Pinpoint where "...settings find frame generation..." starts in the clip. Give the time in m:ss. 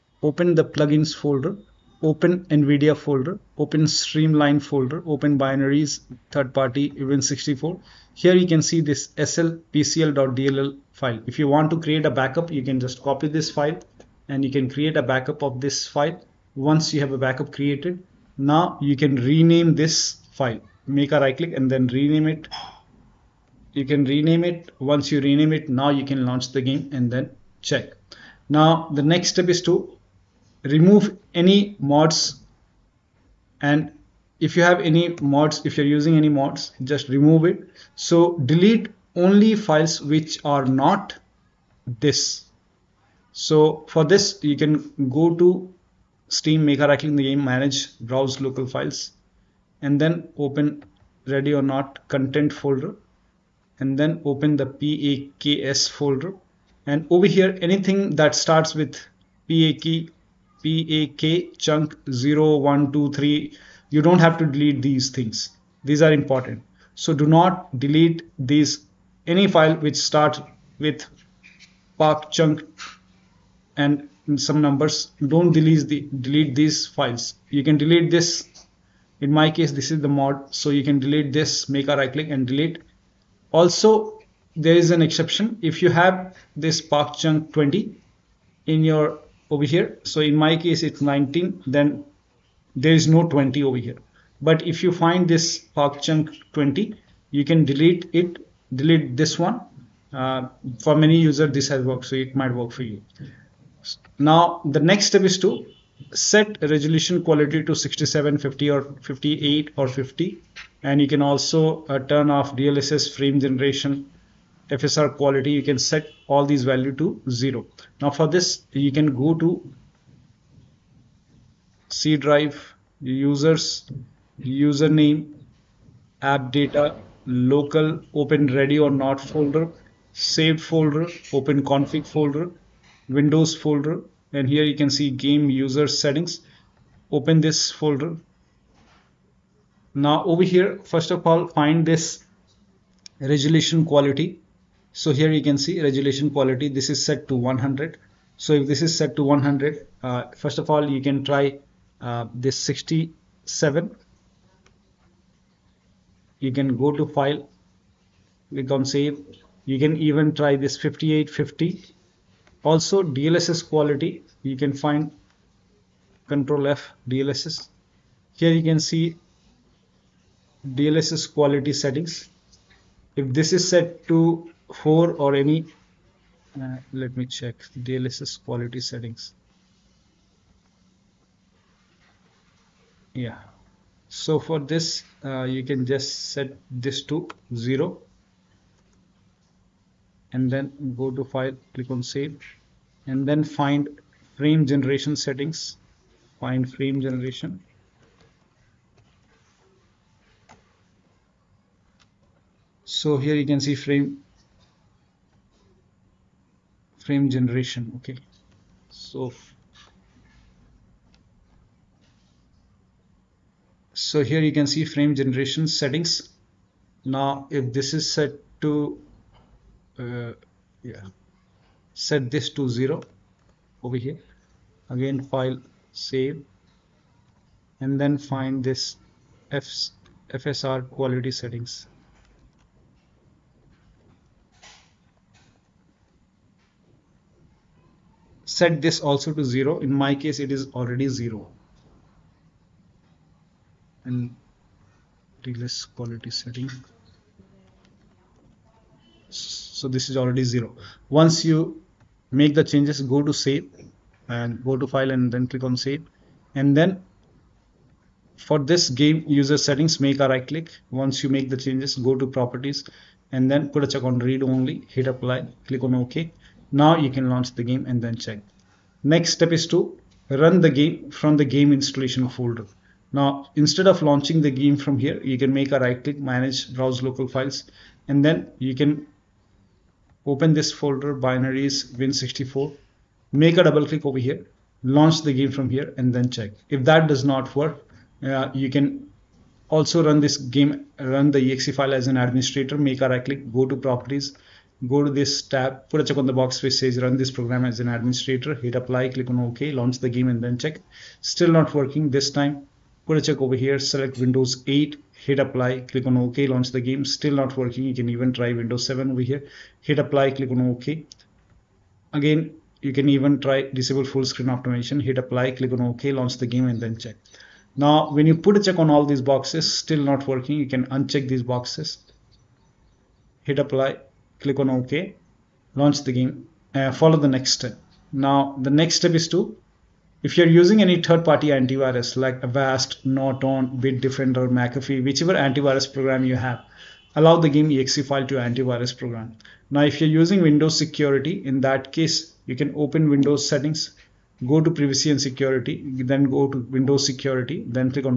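3:15.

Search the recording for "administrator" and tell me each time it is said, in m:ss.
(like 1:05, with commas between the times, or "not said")
4:52, 4:57.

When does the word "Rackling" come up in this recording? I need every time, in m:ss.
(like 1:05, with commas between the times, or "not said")
0:46.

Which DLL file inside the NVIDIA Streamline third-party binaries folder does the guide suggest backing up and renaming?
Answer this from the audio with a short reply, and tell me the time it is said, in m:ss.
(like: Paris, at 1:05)
slpcl.dll, at 0:09.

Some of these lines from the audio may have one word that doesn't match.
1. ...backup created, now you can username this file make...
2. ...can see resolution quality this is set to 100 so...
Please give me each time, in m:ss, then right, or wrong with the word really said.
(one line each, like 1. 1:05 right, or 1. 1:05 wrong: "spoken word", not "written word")
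1. 0:17 wrong: "rename", not "username"
2. 2:25 right.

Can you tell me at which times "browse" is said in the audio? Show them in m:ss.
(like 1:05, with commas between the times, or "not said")
0:47, 4:36.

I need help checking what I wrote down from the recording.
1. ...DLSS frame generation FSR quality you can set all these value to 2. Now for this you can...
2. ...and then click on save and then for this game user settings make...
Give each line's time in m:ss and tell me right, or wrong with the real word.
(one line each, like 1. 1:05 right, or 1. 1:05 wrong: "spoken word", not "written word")
1. 1:52 wrong: "0", not "2"
2. 4:15 right.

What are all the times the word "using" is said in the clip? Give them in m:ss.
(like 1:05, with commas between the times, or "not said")
0:35, 5:30, 5:40.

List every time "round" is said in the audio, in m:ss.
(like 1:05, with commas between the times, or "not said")
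not said.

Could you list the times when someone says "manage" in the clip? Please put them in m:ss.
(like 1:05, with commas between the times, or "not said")
0:47, 4:36.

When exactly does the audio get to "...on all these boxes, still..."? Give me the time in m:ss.
5:18.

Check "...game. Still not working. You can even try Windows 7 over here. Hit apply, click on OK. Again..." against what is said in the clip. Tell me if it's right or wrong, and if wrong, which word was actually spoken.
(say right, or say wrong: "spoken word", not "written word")
right.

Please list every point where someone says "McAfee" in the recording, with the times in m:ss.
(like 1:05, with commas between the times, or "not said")
5:34.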